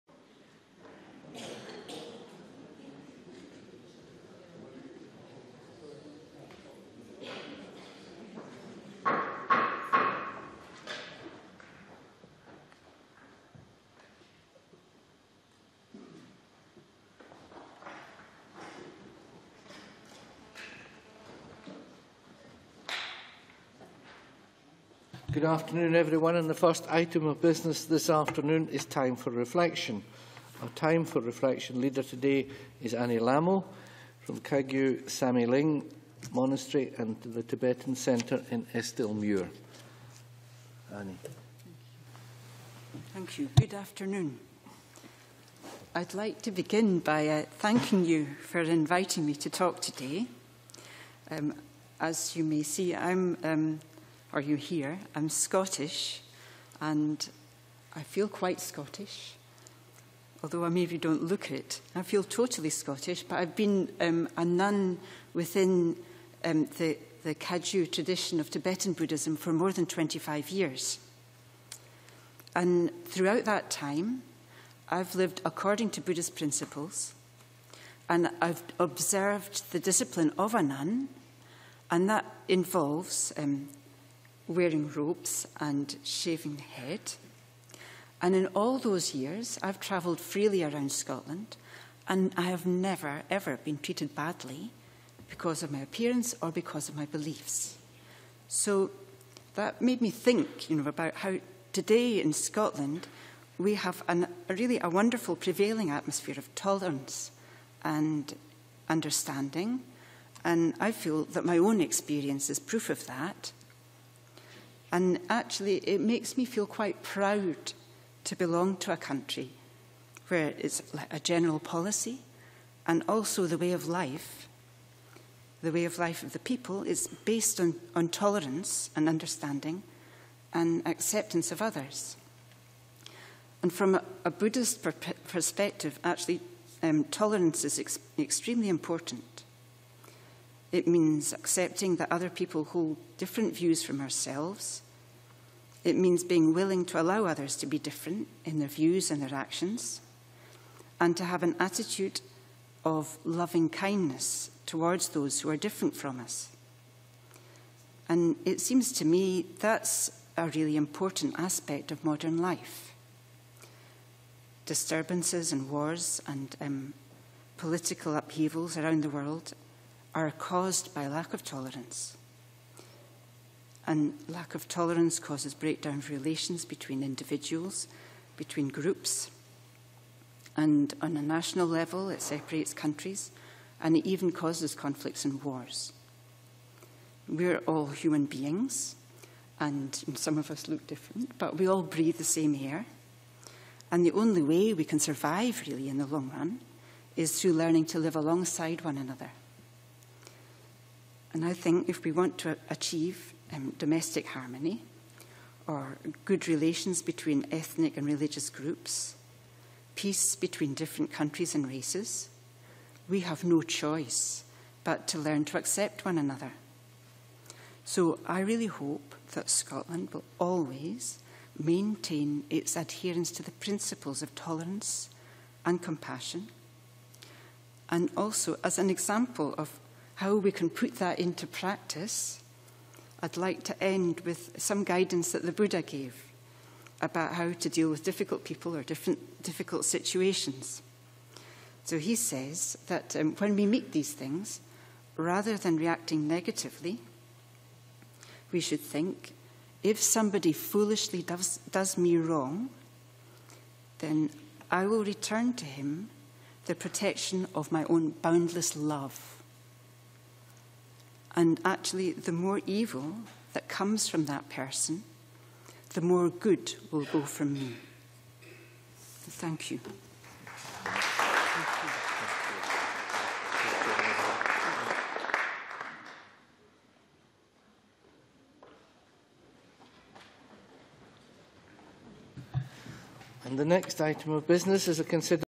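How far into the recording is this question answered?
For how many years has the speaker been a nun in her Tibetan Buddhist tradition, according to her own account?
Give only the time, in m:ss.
1:09.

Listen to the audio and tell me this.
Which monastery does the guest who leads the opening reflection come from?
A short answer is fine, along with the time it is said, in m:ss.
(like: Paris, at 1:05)
Kagyu Sami Ling Monastery, at 0:34.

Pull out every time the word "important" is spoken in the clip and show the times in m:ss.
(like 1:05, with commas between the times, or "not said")
2:18, 2:40.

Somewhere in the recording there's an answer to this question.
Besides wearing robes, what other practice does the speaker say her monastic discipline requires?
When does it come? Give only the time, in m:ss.
1:26.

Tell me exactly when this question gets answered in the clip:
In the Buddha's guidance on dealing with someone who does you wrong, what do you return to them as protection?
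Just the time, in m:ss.
4:18.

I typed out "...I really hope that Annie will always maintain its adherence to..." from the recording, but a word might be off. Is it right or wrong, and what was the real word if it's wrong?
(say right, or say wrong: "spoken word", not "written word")
wrong: "Scotland", not "Annie".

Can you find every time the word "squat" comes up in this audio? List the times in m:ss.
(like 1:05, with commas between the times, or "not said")
not said.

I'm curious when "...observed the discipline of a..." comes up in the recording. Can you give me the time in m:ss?
1:18.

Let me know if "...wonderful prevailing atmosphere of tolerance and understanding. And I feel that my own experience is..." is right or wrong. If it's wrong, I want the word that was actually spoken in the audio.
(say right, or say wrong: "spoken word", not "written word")
right.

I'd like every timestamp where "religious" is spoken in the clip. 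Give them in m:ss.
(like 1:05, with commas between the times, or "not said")
3:28.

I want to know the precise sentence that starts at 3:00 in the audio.
And on a national level, it separates countries and it even causes conflicts and wars.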